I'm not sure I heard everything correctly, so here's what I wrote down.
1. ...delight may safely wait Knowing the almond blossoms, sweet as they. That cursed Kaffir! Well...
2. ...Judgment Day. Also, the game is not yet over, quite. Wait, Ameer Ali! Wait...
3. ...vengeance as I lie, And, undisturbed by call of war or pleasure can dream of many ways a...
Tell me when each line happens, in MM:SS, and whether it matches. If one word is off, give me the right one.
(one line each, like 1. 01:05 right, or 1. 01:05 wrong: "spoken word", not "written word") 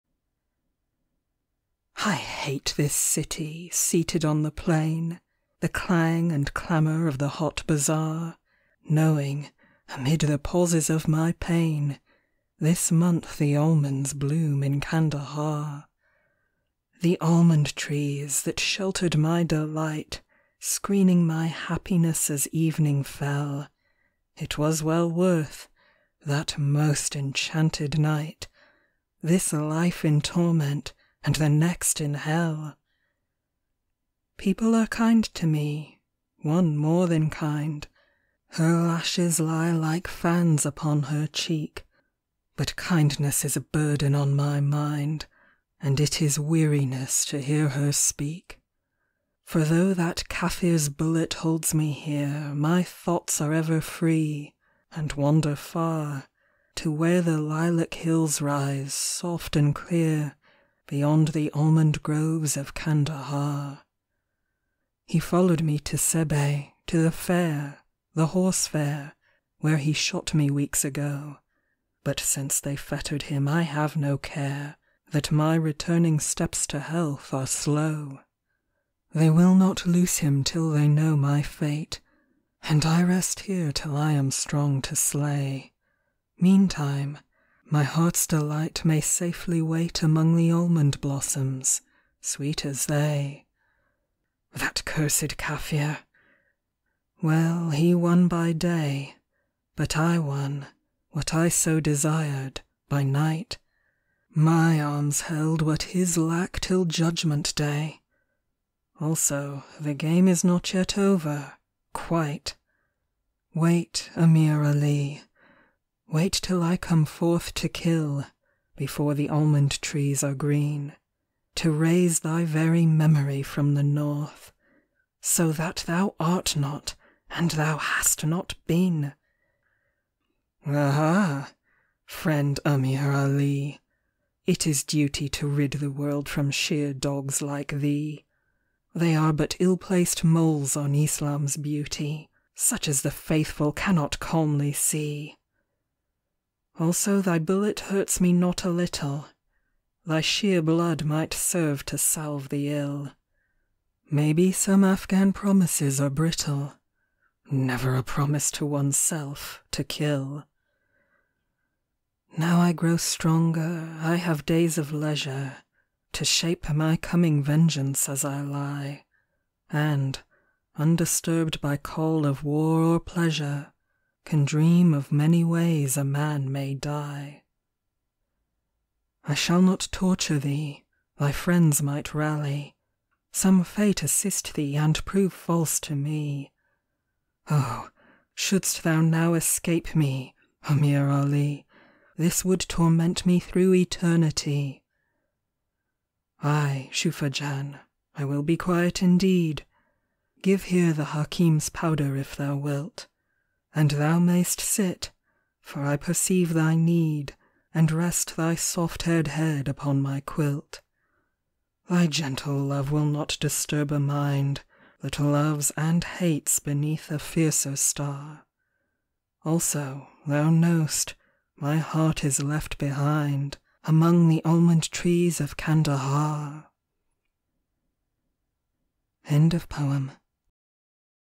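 1. 01:28 wrong: "Among", not "Knowing"
2. 01:46 right
3. 02:47 right.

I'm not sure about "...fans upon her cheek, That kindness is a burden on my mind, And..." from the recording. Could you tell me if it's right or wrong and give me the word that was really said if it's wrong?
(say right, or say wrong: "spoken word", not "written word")
wrong: "But", not "That".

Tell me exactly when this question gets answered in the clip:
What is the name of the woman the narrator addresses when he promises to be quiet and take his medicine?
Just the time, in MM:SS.
03:16.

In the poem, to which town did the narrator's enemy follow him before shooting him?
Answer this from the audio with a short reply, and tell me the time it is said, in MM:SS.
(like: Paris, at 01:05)
Sibi, at 01:05.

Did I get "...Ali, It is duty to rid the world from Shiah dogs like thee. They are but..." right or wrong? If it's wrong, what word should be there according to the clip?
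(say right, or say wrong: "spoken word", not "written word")
right.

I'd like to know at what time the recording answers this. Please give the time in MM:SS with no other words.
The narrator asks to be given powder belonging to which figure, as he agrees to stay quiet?
03:21.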